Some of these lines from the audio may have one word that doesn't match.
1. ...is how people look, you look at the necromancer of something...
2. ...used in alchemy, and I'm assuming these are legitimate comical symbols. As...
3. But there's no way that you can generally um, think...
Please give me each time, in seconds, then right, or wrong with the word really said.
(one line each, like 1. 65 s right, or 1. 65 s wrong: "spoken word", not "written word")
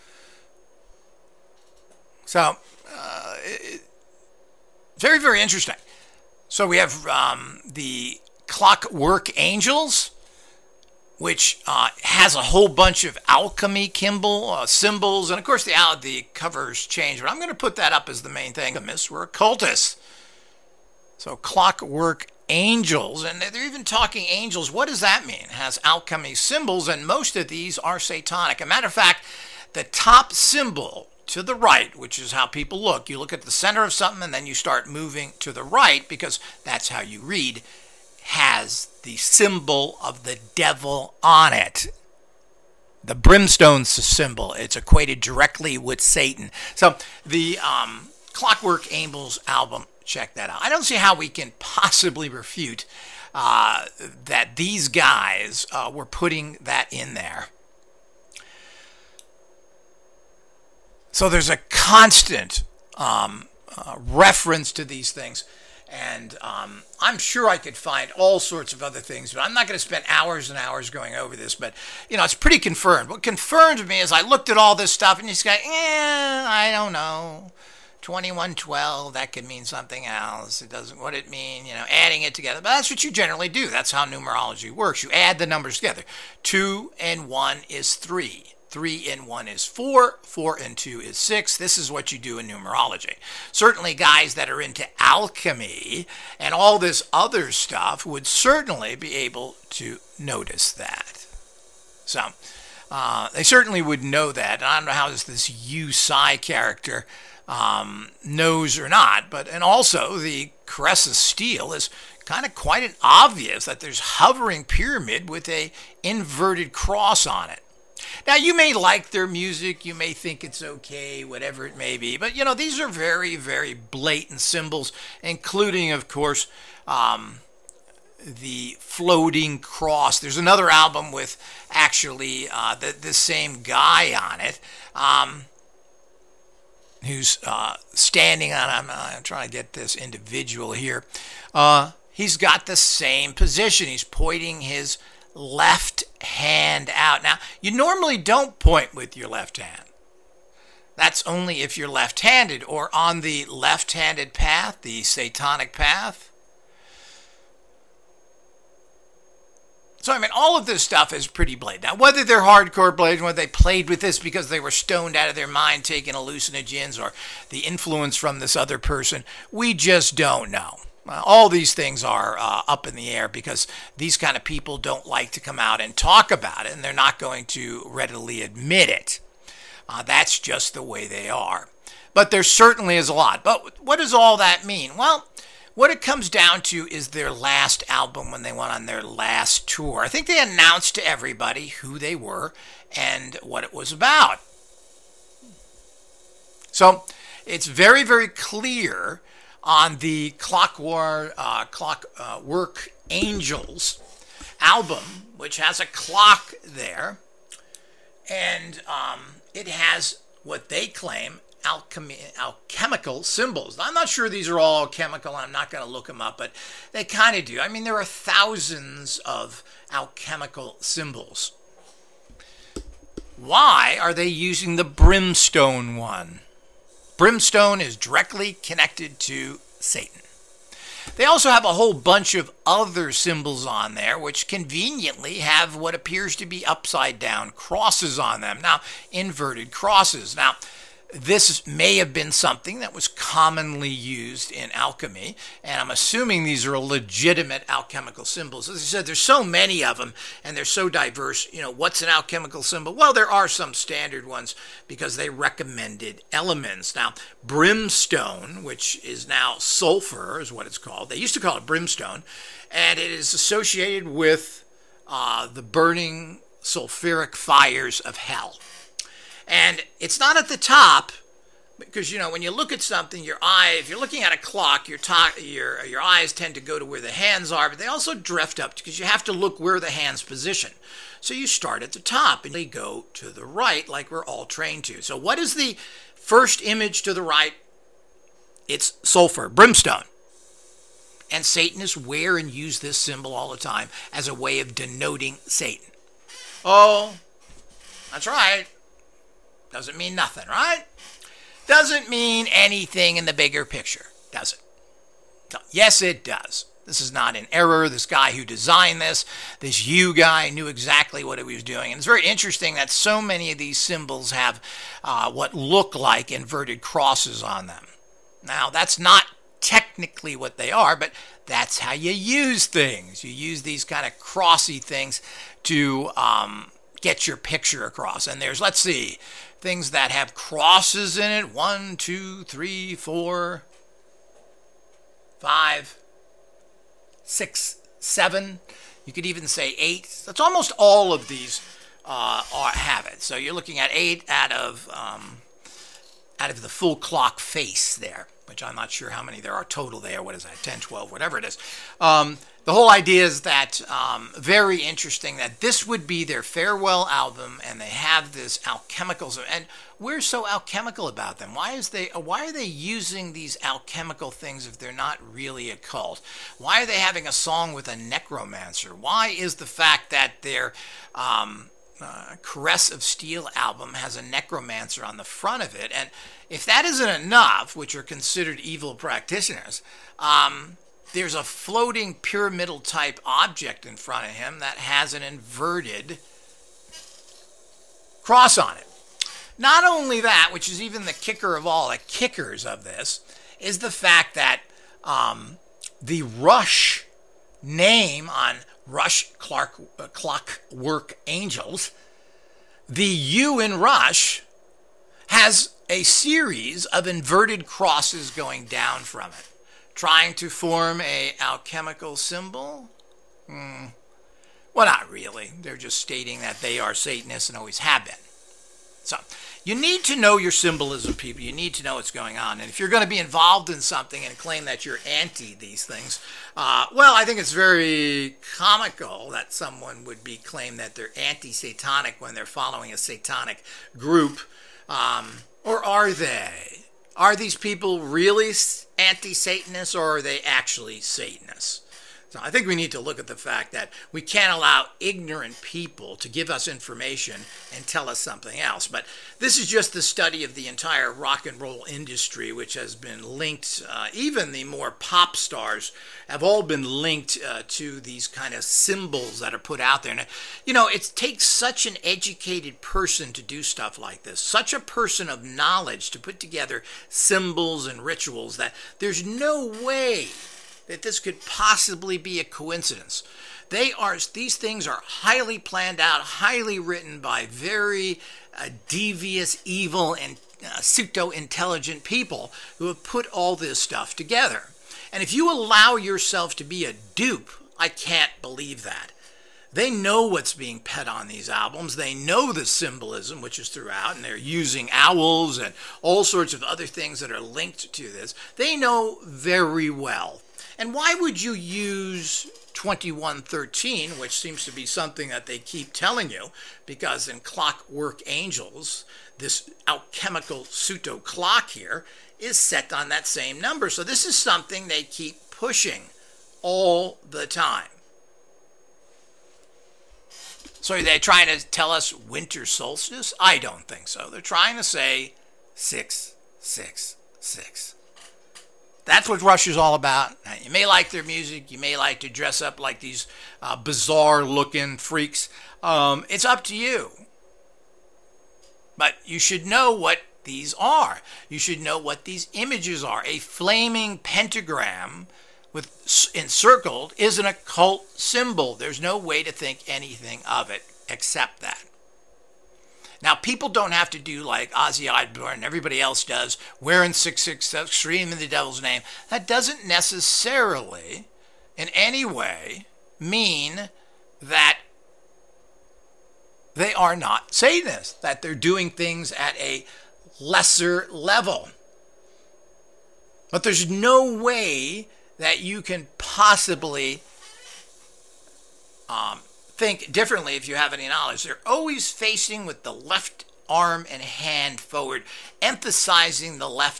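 1. 32 s wrong: "center", not "necromancer"
2. 243 s wrong: "alchemical", not "comical"
3. 573 s wrong: "possibly", not "generally".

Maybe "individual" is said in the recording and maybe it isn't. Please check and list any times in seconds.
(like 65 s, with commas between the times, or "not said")
139 s.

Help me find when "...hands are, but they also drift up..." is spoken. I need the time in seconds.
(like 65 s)
277 s.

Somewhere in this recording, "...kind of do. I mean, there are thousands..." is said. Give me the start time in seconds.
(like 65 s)
217 s.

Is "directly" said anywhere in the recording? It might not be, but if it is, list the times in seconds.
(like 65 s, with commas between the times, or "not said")
45 s, 227 s.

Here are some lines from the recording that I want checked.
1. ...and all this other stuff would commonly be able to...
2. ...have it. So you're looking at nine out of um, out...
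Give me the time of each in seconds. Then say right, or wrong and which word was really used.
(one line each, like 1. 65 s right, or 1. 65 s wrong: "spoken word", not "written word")
1. 96 s wrong: "certainly", not "commonly"
2. 342 s wrong: "eight", not "nine".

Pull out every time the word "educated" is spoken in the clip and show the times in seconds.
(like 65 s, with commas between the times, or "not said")
462 s.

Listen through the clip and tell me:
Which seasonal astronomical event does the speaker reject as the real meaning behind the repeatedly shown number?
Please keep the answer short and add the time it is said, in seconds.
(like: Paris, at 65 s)
winter solstice, at 522 s.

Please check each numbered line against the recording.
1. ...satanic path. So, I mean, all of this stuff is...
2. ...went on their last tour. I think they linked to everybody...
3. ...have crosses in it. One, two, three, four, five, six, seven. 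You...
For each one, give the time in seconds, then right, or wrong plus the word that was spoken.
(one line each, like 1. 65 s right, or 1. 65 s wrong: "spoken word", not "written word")
1. 155 s right
2. 188 s wrong: "announced", not "linked"
3. 330 s right.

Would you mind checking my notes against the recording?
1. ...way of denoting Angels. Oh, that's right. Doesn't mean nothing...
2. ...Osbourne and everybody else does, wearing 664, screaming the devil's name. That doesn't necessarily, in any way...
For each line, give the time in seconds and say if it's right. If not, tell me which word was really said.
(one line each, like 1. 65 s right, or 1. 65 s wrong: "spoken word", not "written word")
1. 294 s wrong: "Satan", not "Angels"
2. 555 s wrong: "666", not "664".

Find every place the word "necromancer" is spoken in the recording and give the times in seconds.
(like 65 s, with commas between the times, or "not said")
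367 s, 374 s.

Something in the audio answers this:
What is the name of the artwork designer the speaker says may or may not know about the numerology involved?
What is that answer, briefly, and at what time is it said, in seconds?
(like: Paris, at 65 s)
Hugh Syme, at 105 s.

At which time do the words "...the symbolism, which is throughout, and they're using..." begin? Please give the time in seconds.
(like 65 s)
492 s.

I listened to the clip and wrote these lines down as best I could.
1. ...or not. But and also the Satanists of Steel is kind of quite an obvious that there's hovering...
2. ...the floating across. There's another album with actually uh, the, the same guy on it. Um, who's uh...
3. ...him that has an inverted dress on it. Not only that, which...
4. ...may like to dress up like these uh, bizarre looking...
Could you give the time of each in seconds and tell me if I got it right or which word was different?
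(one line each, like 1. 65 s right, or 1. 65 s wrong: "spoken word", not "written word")
1. 108 s wrong: "Caress", not "Satanists"
2. 128 s wrong: "cross", not "across"
3. 384 s wrong: "cross", not "dress"
4. 531 s right.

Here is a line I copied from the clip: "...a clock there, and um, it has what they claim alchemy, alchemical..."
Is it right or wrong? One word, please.
right.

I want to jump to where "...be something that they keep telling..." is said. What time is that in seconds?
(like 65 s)
504 s.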